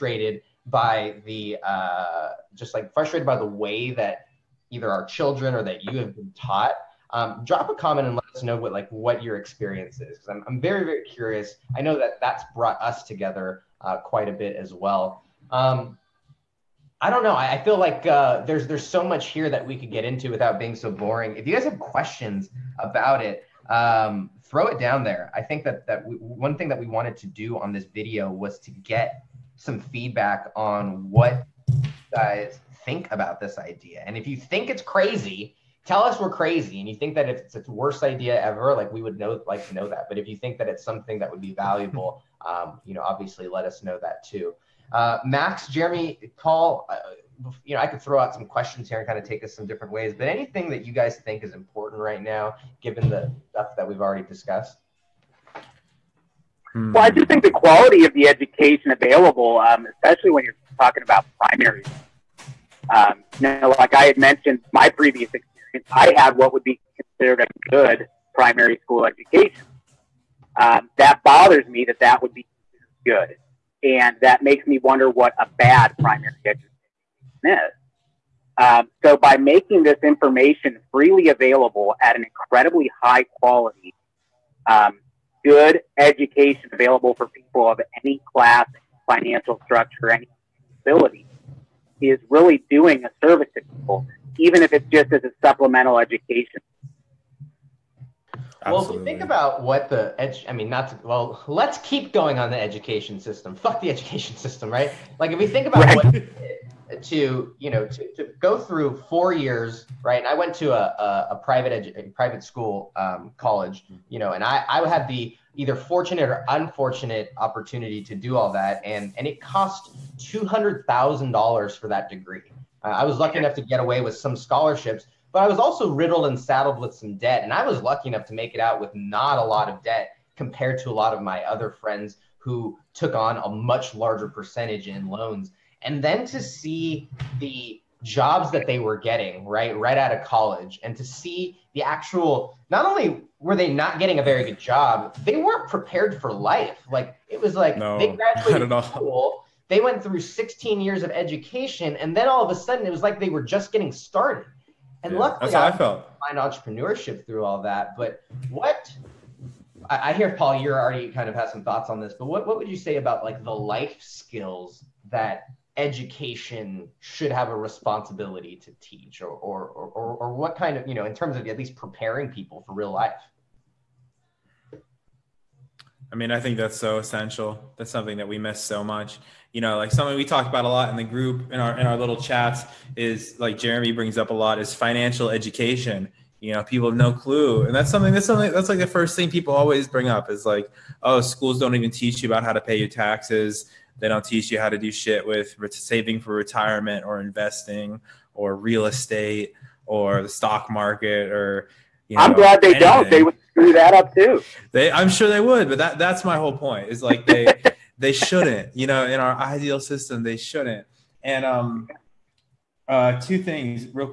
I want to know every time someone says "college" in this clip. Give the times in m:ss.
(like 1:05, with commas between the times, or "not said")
1:53, 2:20.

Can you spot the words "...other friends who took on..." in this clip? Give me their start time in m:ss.
2:11.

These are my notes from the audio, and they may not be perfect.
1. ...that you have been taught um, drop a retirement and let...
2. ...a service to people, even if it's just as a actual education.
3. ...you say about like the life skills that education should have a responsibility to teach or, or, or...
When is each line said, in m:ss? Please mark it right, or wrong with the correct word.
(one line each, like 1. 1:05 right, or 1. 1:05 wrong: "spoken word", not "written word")
1. 0:05 wrong: "comment", not "retirement"
2. 1:33 wrong: "supplemental", not "actual"
3. 2:42 right.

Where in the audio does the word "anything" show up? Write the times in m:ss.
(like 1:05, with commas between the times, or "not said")
0:50, 3:22.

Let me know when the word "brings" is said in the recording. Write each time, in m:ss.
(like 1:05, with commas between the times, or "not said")
3:03, 3:09.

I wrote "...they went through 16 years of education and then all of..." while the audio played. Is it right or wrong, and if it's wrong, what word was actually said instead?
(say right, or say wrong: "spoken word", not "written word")
right.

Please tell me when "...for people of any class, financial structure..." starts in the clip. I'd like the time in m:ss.
1:27.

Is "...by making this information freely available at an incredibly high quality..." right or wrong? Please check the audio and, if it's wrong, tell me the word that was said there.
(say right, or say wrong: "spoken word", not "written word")
right.